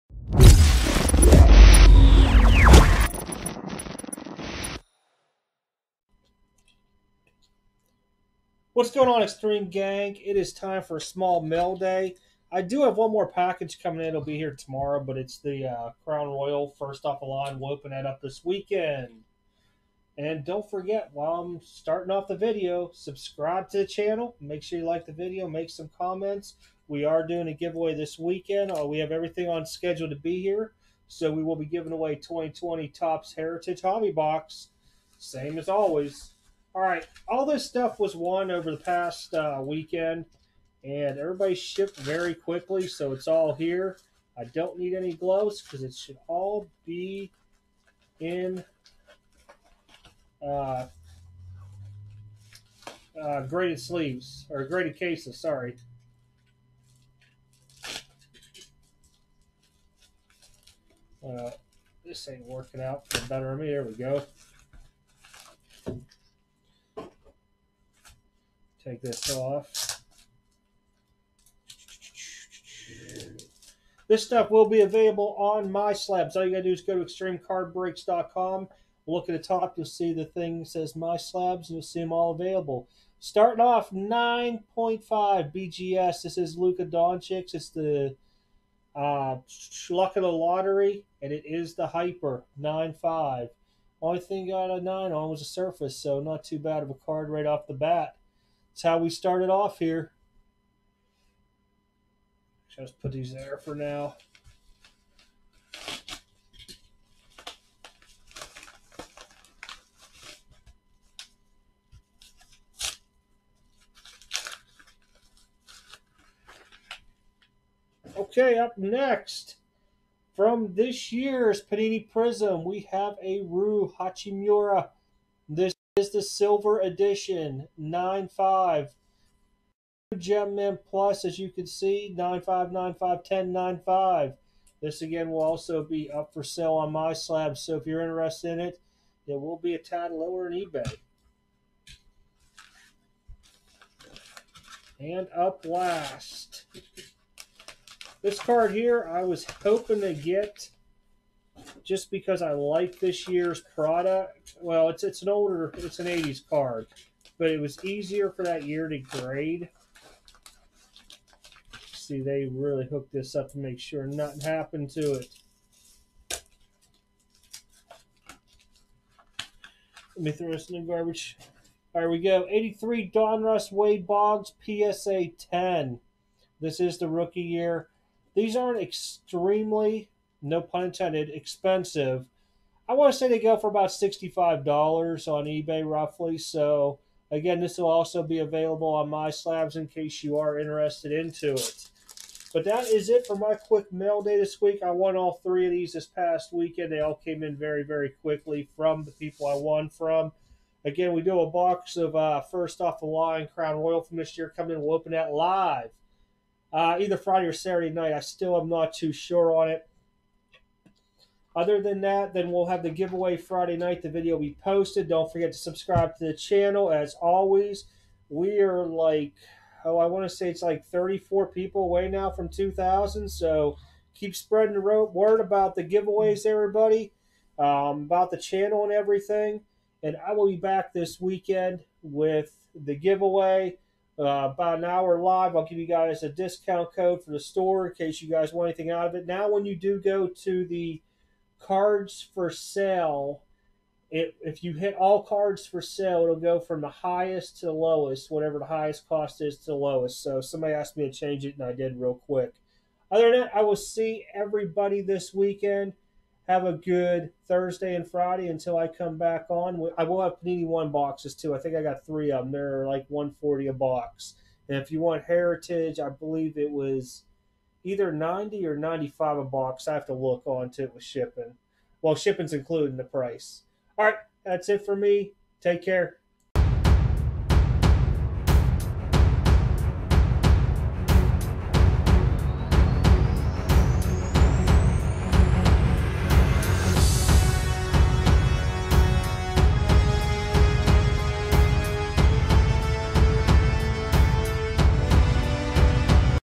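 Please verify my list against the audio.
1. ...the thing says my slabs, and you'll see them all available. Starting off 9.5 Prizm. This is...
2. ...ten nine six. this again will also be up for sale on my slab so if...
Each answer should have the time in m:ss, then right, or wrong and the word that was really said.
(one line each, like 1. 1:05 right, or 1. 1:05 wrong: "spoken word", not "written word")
1. 1:20 wrong: "BGS", not "Prizm"
2. 2:13 wrong: "five", not "six".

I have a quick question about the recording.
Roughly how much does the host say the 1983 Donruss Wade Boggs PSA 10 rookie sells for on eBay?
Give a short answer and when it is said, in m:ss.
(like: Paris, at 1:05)
$65, at 3:03.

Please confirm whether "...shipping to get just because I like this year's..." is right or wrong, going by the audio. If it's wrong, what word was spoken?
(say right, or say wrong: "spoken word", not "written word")
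wrong: "hoping", not "shipping".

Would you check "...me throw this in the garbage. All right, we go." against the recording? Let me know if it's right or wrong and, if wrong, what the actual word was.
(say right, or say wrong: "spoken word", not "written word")
right.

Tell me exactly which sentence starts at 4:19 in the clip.
I will have Panini One boxes too.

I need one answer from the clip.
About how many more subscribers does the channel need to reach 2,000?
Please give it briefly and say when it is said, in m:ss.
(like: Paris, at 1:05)
34, at 3:40.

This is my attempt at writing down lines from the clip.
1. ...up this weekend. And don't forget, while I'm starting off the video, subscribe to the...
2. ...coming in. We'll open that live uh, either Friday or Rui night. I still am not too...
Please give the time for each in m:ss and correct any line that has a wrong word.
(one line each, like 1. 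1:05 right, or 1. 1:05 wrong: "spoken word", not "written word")
1. 0:18 right
2. 3:24 wrong: "Saturday", not "Rui".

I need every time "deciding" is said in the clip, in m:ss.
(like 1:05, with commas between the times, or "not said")
not said.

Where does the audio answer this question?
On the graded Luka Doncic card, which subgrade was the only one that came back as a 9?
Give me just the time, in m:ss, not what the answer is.
1:35.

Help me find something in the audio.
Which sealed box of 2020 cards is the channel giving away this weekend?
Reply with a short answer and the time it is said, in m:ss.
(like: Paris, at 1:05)
Topps Heritage Hobby Box, at 0:32.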